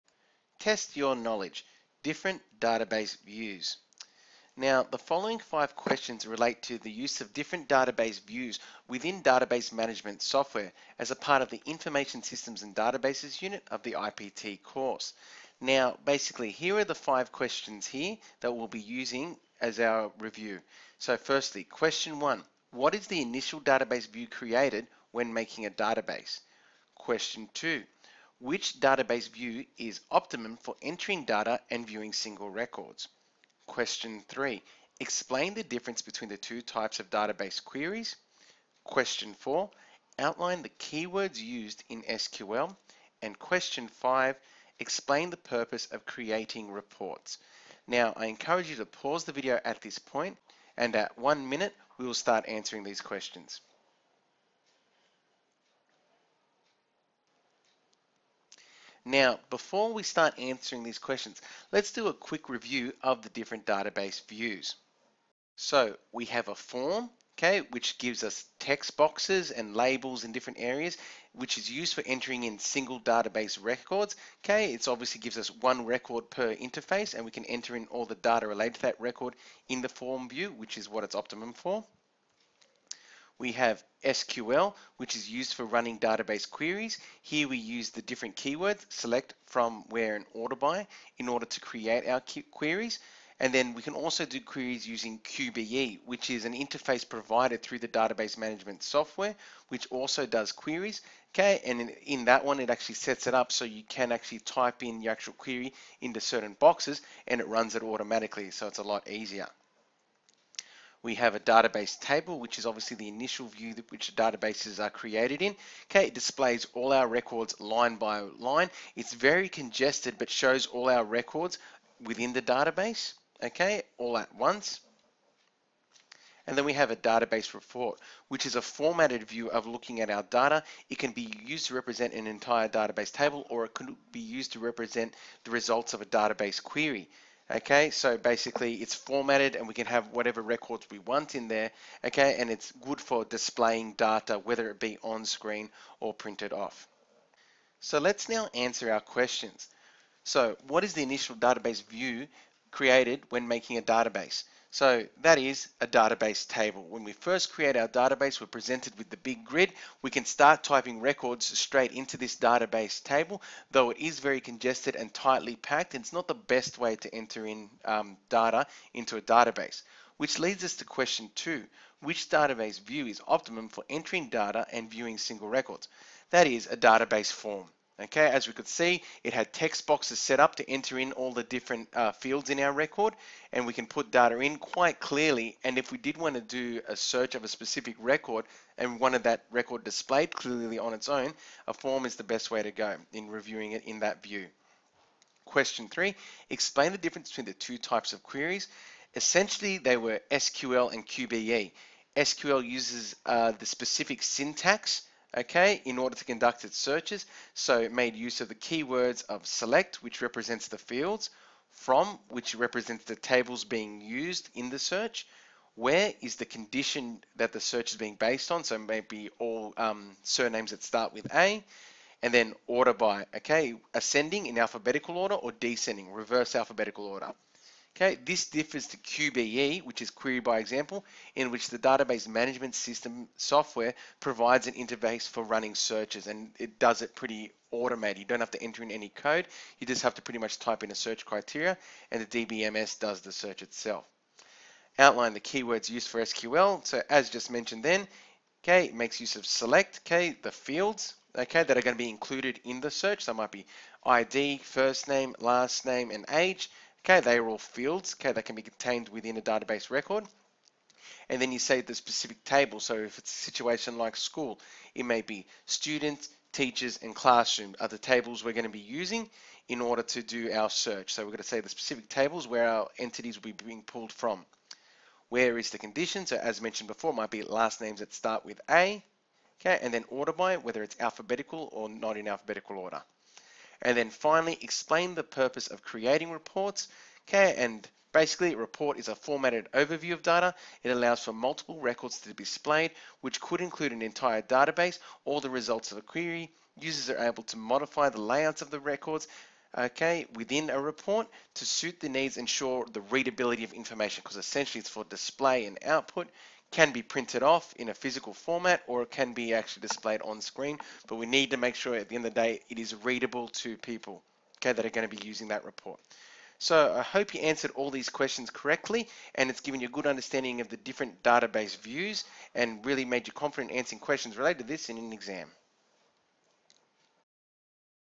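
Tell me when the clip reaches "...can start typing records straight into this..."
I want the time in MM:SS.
02:40.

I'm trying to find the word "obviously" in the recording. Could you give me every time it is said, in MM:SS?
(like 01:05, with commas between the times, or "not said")
01:14, 01:52.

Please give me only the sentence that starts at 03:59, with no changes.
You just have to pretty much type in a search criteria and the DBMS does the search itself.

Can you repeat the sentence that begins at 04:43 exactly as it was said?
And then finally, explain the purpose of creating reports, okay, and basically a report is a formatted overview of data.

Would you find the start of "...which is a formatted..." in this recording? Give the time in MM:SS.
02:08.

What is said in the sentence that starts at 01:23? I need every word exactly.
We have SQL, which is used for running database queries.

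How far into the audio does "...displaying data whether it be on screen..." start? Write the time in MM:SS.
02:23.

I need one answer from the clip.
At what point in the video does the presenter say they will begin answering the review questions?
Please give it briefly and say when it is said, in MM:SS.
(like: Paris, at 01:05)
1 minute, at 00:51.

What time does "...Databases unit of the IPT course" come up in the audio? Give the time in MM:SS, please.
00:12.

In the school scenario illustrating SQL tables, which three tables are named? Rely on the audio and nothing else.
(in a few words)
students, teachers, and classroom.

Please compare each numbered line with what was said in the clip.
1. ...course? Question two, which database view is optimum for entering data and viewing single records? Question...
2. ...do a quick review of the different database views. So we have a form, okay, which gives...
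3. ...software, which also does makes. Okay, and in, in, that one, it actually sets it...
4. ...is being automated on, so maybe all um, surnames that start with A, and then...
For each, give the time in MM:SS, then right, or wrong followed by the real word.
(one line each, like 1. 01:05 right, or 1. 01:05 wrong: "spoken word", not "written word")
1. 00:25 wrong: "database", not "course"
2. 01:01 right
3. 01:38 wrong: "queries", not "makes"
4. 03:37 wrong: "based", not "automated".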